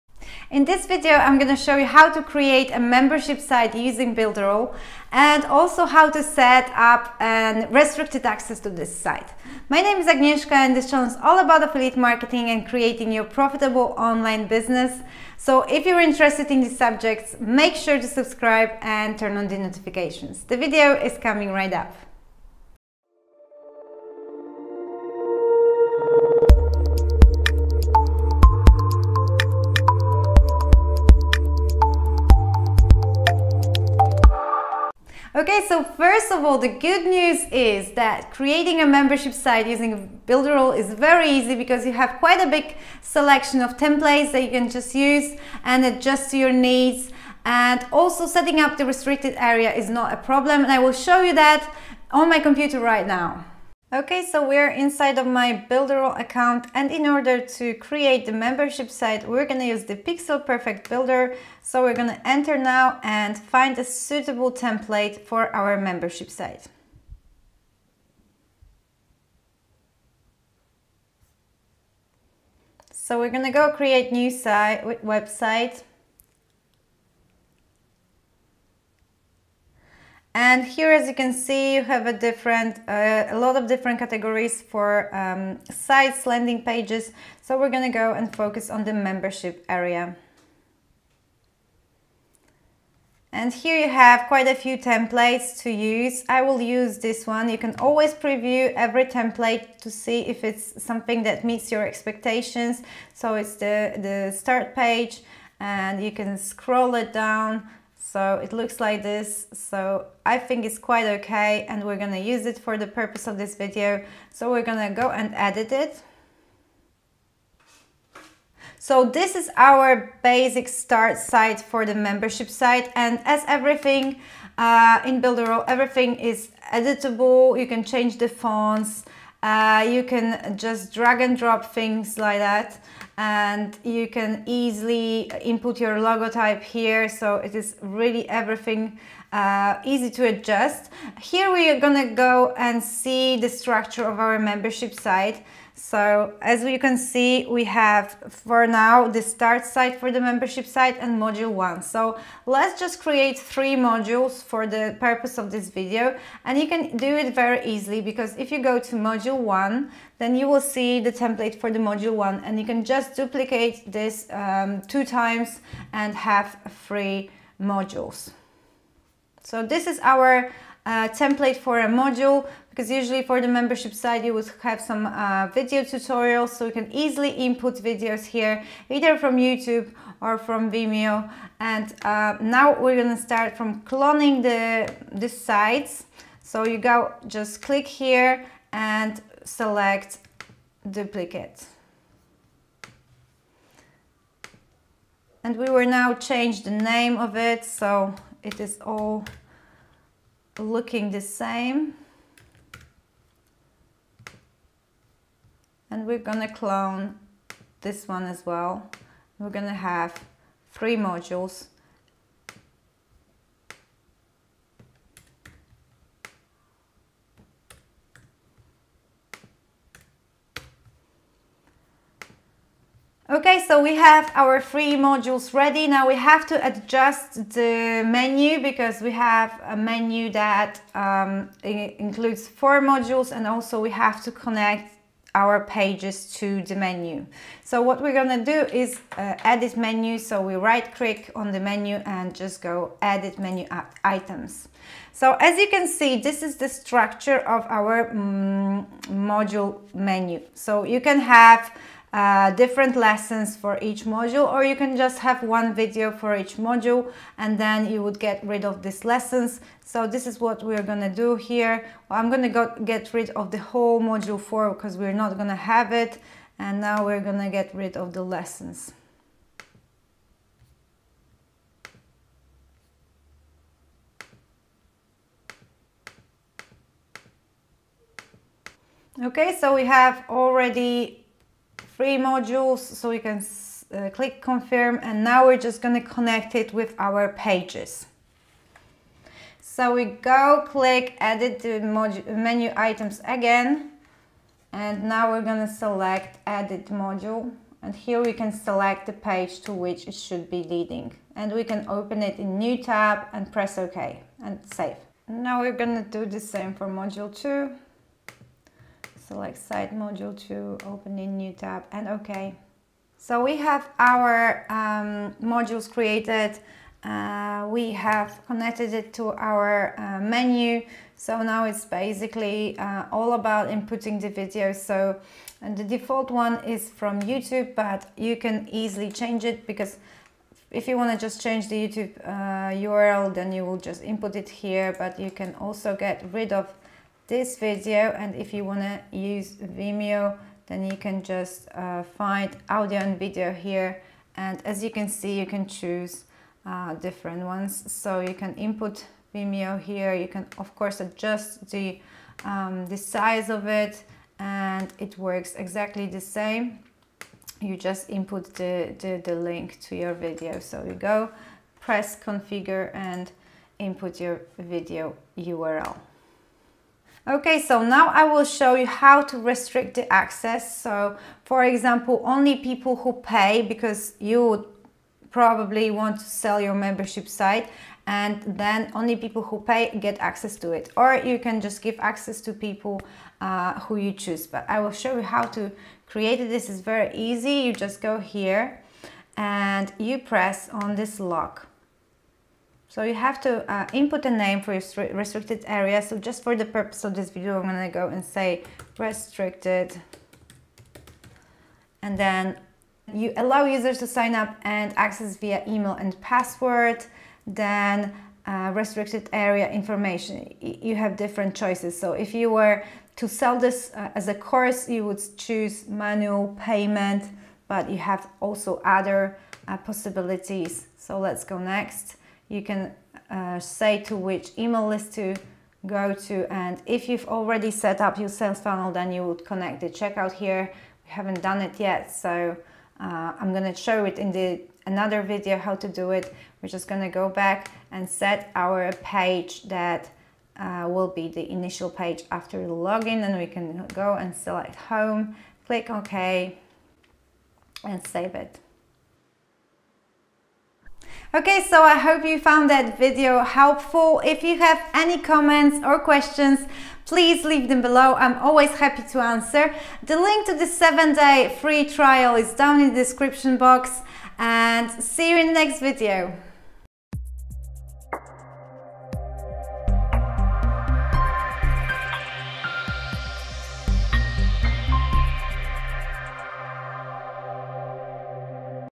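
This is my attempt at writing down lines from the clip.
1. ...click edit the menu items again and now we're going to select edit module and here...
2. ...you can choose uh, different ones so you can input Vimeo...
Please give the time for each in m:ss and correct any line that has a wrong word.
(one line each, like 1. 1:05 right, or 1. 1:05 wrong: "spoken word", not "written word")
1. 4:50 right
2. 5:45 right.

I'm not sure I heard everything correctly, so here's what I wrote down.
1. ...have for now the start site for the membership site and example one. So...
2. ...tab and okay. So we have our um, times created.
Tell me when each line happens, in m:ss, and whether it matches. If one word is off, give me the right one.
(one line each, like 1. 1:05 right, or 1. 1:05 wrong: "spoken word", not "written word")
1. 2:27 wrong: "module", not "example"
2. 5:11 wrong: "modules", not "times".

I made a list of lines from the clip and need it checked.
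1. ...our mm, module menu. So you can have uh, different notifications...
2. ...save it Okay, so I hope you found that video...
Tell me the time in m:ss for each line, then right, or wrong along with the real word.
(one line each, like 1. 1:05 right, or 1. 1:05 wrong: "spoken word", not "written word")
1. 4:07 wrong: "lessons", not "notifications"
2. 7:28 right.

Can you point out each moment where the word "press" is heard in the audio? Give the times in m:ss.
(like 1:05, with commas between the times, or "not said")
5:03, 6:01, 6:30.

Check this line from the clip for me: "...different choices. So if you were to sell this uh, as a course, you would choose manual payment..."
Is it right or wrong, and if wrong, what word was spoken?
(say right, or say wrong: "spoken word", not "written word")
right.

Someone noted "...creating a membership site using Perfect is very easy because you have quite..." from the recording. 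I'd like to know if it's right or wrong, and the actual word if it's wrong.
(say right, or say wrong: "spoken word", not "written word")
wrong: "Builderall", not "Perfect".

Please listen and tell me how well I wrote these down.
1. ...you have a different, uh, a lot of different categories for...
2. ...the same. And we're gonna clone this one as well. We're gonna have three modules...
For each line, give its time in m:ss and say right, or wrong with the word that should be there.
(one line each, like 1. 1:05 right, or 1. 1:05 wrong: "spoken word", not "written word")
1. 1:21 right
2. 3:21 right.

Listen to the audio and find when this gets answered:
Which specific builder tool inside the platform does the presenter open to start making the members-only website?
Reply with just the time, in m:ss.
0:59.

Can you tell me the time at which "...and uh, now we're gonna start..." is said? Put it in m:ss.
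3:01.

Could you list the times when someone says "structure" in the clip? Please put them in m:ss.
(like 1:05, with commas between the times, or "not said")
2:23, 4:06.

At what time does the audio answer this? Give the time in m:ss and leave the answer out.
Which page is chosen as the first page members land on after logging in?
7:24.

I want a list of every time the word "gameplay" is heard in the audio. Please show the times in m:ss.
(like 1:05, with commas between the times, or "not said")
not said.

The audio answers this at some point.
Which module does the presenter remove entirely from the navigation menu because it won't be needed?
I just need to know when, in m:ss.
4:24.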